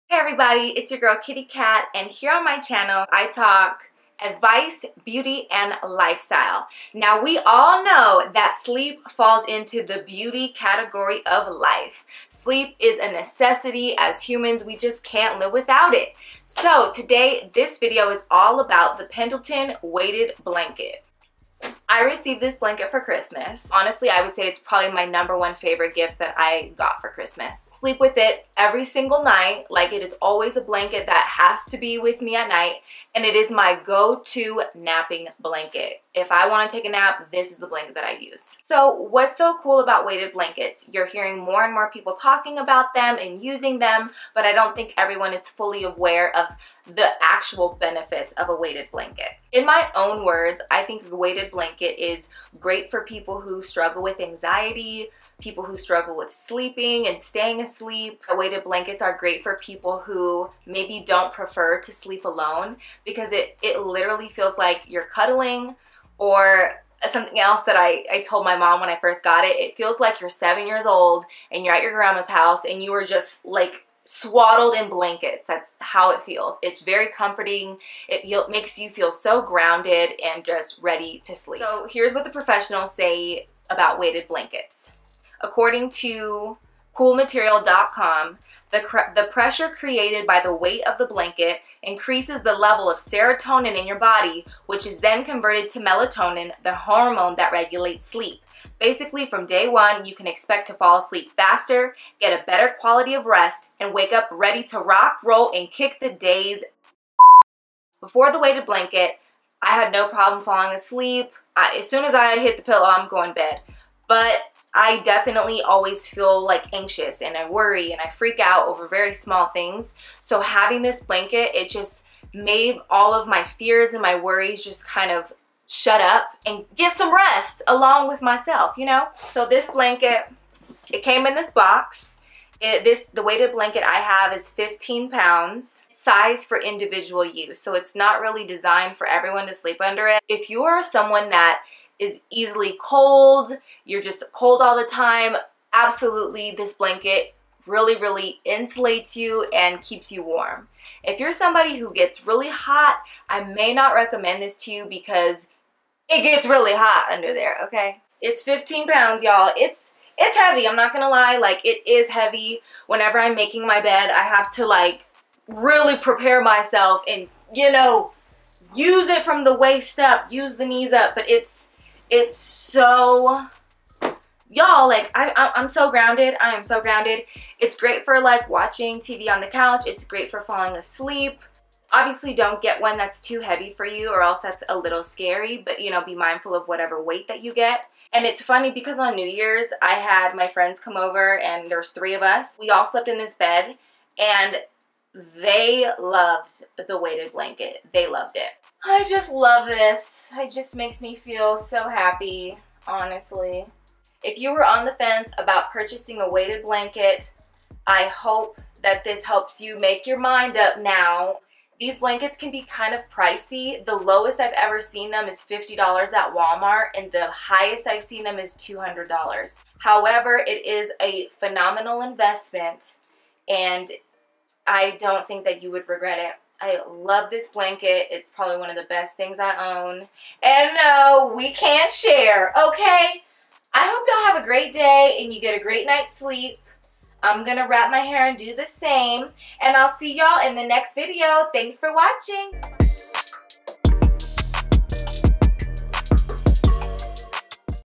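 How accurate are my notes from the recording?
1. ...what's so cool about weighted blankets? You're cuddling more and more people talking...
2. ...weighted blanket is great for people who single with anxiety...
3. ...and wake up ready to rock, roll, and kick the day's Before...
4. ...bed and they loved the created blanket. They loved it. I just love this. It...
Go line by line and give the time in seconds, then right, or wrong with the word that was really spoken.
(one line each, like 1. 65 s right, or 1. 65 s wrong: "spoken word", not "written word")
1. 38 s wrong: "hearing", not "cuddling"
2. 51 s wrong: "struggle", not "single"
3. 103 s right
4. 193 s wrong: "weighted", not "created".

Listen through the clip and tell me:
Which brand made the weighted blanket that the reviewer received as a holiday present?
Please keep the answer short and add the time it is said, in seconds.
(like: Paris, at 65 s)
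Pendleton, at 19 s.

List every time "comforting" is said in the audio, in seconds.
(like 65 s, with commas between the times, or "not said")
77 s.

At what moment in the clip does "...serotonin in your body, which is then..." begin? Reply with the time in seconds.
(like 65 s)
92 s.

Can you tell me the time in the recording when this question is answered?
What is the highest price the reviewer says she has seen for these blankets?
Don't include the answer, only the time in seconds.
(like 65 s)
218 s.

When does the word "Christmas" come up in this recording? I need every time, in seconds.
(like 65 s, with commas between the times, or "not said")
23 s, 27 s.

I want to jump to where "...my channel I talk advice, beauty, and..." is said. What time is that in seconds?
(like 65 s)
2 s.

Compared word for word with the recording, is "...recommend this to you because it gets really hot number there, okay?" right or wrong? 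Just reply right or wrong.
wrong.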